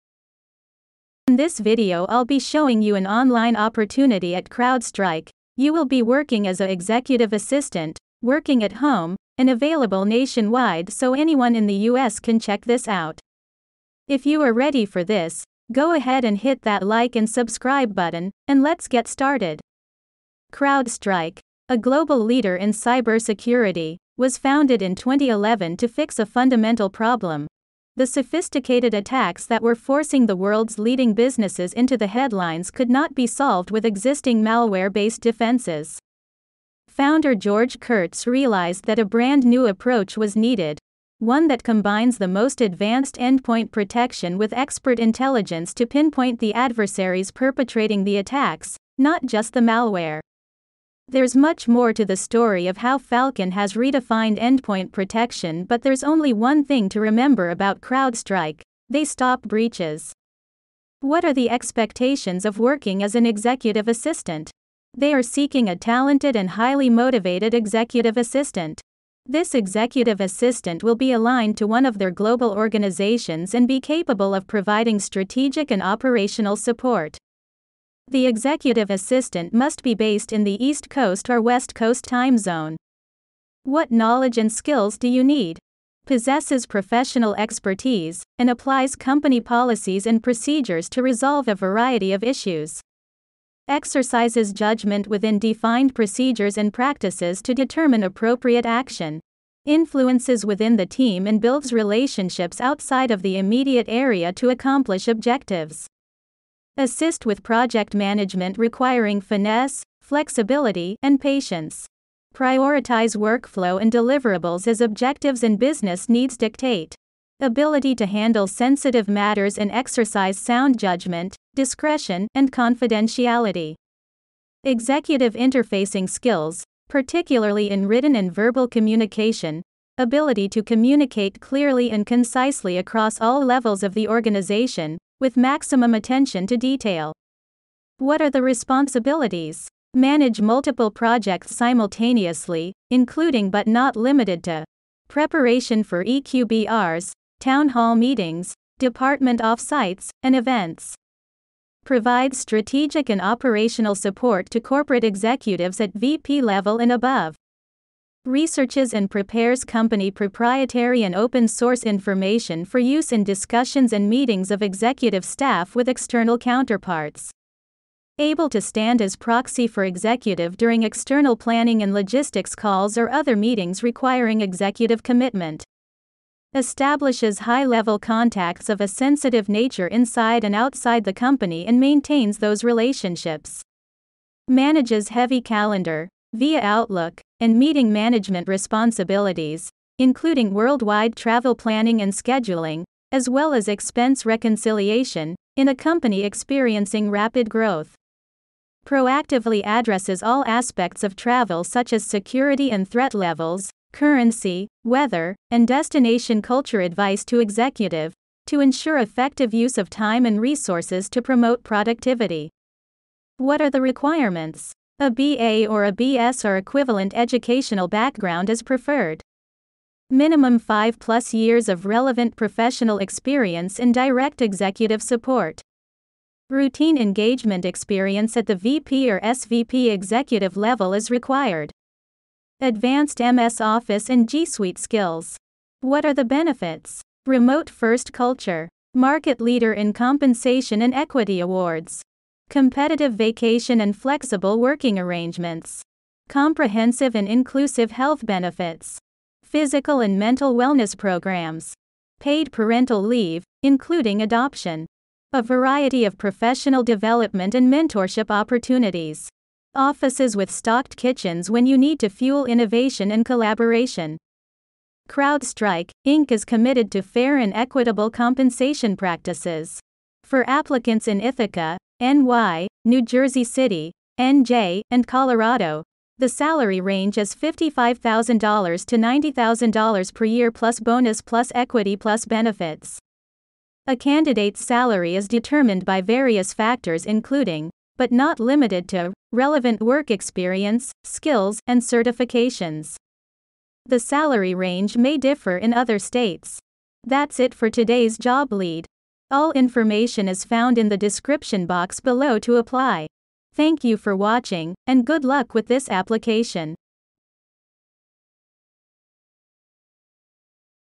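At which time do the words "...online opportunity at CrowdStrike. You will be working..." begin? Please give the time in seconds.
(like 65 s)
3 s.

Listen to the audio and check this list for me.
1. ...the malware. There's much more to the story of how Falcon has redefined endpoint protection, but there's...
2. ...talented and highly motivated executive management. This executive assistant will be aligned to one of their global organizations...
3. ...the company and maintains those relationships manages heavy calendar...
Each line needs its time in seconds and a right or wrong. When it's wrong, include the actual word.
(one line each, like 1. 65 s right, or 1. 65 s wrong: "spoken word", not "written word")
1. 49 s right
2. 65 s wrong: "assistant", not "management"
3. 181 s right.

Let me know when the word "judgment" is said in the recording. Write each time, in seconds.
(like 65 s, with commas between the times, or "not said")
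94 s, 120 s.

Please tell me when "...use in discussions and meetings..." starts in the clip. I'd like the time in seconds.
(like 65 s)
162 s.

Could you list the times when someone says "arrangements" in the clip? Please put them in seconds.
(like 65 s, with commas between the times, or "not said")
244 s.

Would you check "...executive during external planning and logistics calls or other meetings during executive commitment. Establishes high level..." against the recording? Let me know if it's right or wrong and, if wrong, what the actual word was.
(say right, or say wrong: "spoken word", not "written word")
wrong: "requiring", not "during".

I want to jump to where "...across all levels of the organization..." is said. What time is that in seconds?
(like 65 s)
132 s.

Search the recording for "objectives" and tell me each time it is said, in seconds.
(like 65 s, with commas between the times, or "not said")
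105 s, 114 s.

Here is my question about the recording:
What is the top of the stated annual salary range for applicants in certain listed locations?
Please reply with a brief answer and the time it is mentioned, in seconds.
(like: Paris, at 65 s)
$90,000, at 278 s.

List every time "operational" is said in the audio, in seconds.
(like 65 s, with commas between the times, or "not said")
75 s, 153 s.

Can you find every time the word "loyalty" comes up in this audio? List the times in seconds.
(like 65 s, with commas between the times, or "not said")
not said.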